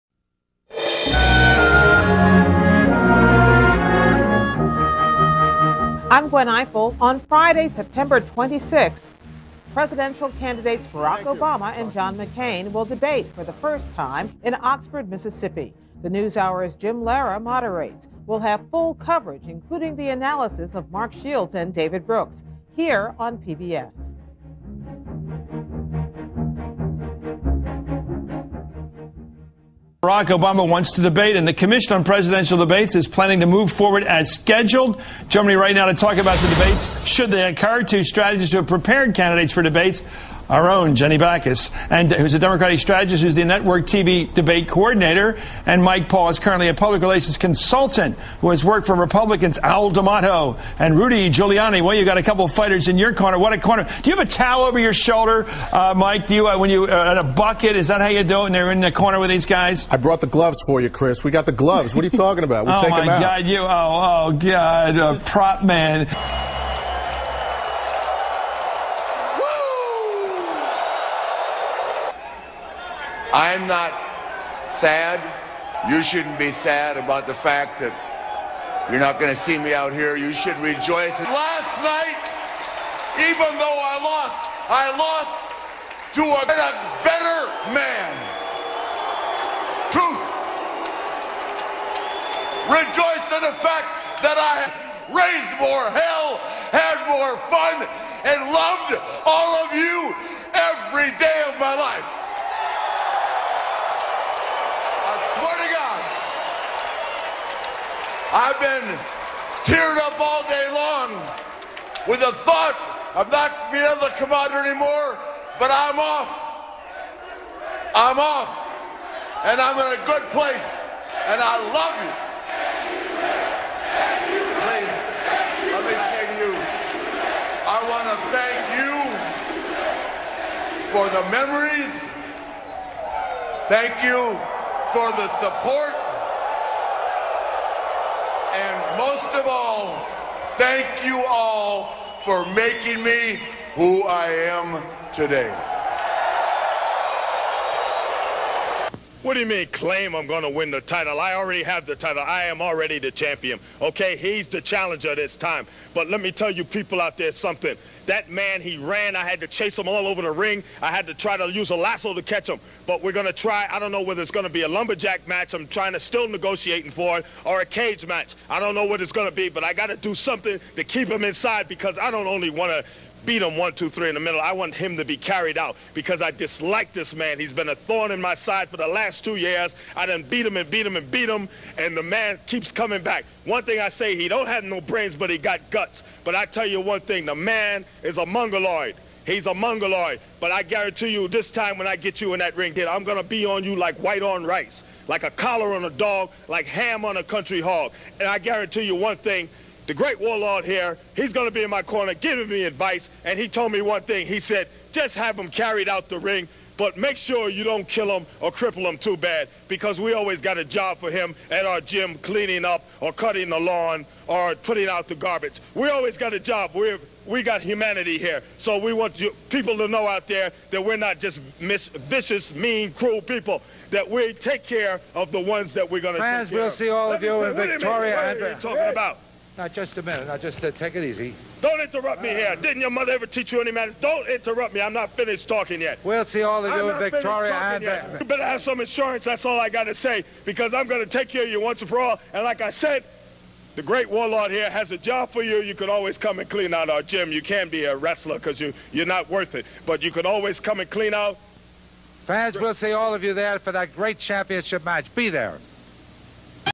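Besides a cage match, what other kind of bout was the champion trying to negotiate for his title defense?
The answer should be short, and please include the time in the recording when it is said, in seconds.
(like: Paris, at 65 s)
Lumberjack match, at 164 s.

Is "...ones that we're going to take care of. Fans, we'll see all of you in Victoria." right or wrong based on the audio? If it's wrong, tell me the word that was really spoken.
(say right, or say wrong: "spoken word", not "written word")
right.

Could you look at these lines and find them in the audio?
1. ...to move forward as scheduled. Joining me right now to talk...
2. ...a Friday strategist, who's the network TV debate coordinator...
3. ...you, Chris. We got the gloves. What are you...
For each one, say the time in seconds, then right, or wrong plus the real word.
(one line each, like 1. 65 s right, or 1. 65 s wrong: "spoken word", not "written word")
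1. 33 s right
2. 42 s wrong: "Democratic", not "Friday"
3. 60 s right.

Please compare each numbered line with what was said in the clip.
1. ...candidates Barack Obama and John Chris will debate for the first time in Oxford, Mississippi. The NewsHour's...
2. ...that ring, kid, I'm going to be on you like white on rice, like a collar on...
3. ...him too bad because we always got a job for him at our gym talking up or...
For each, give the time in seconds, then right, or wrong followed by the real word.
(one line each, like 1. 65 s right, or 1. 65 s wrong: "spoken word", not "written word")
1. 10 s wrong: "McCain", not "Chris"
2. 192 s right
3. 208 s wrong: "cleaning", not "talking".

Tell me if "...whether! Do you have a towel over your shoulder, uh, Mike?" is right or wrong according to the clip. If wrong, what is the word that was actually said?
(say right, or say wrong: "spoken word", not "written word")
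wrong: "corner", not "whether".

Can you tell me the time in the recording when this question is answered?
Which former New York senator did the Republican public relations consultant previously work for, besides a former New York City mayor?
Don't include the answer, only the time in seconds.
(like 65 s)
49 s.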